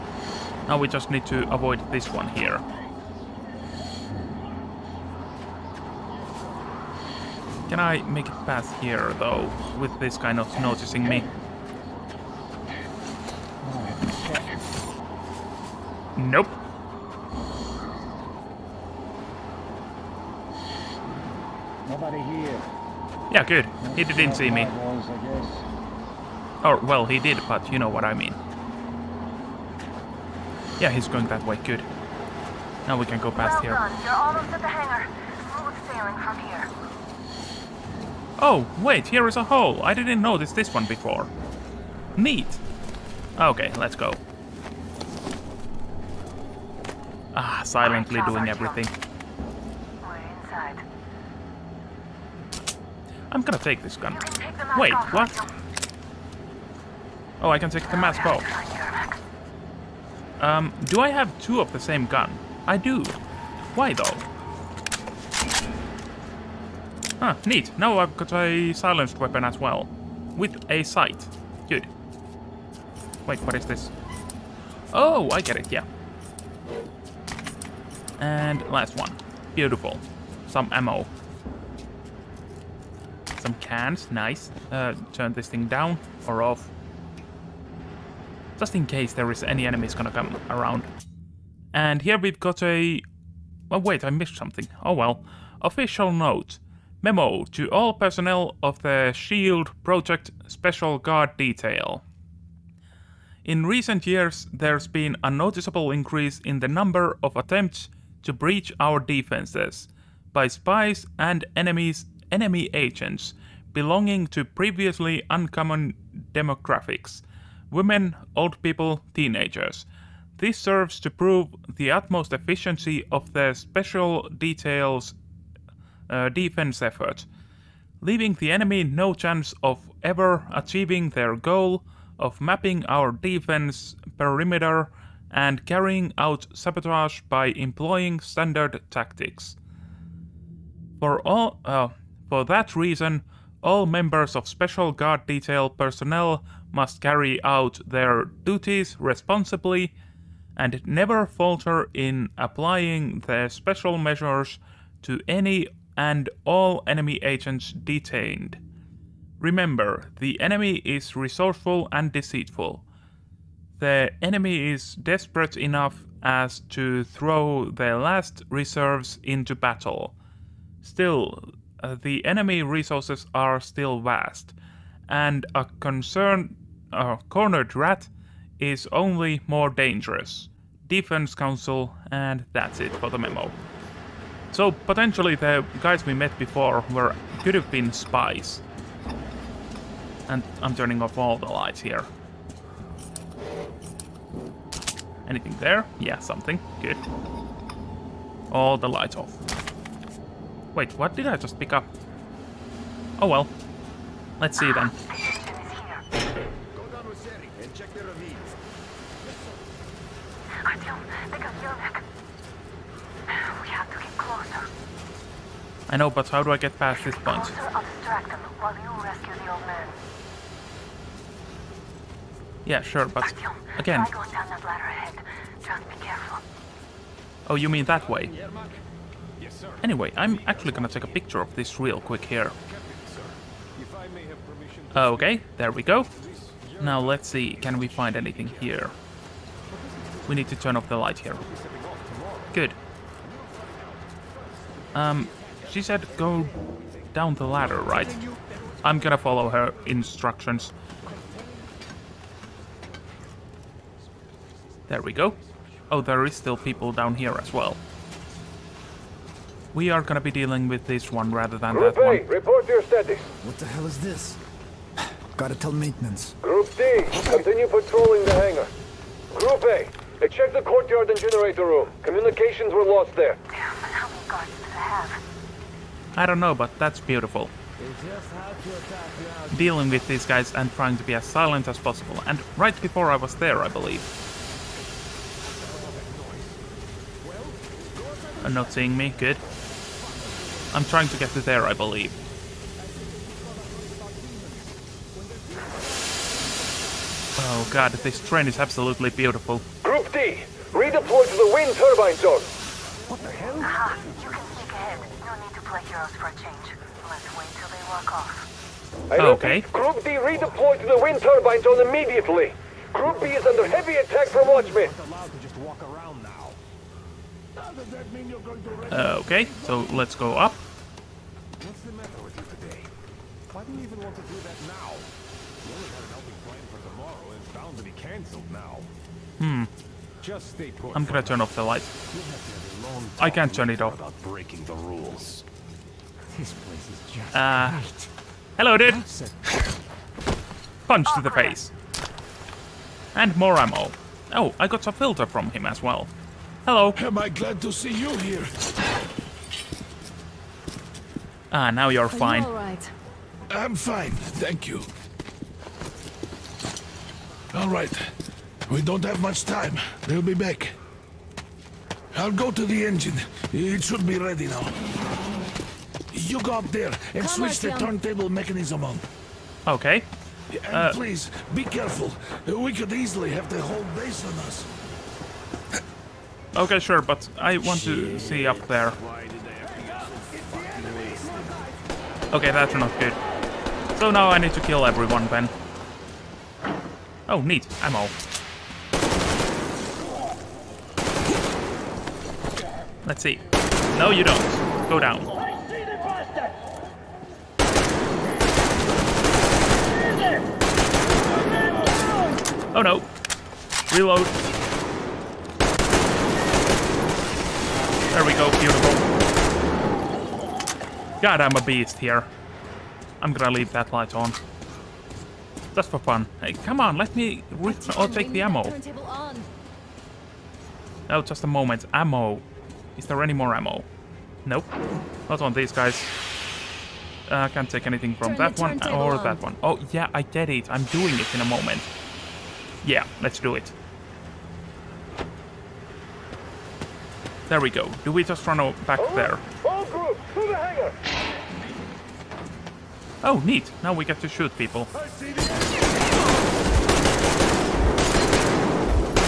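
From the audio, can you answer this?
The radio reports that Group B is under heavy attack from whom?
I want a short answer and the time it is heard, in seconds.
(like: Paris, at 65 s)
Watchmen, at 314 s.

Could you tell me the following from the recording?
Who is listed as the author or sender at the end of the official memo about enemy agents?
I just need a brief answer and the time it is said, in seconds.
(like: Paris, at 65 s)
Defense Council, at 180 s.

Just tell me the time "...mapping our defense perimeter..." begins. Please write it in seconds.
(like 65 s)
132 s.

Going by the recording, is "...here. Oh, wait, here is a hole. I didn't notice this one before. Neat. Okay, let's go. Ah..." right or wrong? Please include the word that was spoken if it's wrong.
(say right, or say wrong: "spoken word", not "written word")
right.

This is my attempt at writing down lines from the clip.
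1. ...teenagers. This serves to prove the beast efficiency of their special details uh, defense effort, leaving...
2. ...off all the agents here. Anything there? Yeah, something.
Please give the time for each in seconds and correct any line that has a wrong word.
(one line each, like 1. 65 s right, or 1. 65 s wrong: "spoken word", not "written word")
1. 119 s wrong: "utmost", not "beast"
2. 191 s wrong: "lights", not "agents".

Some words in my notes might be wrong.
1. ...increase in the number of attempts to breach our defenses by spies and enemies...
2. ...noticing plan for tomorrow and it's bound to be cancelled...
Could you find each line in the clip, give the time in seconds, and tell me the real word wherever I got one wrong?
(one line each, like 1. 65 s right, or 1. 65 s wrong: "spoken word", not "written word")
1. 105 s right
2. 326 s wrong: "helping", not "noticing".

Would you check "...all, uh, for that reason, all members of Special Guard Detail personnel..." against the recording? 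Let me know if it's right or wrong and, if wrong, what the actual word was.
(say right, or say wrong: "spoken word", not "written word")
right.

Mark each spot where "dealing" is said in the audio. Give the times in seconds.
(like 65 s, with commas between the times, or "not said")
260 s, 279 s.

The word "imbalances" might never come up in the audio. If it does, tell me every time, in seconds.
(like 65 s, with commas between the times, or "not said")
not said.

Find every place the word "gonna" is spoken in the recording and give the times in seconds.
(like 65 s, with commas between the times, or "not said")
53 s, 89 s, 230 s, 248 s, 259 s, 331 s, 413 s.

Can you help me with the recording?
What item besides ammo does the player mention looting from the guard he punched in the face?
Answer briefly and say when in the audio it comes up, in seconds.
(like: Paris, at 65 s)
A filter, at 344 s.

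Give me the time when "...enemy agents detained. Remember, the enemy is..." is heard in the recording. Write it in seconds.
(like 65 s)
156 s.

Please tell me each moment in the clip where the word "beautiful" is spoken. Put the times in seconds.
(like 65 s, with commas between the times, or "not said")
79 s, 276 s, 299 s, 408 s.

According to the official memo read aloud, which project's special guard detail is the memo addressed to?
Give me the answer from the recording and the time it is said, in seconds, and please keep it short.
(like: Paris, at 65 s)
SHIELD Project, at 99 s.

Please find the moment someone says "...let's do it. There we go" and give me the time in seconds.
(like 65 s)
433 s.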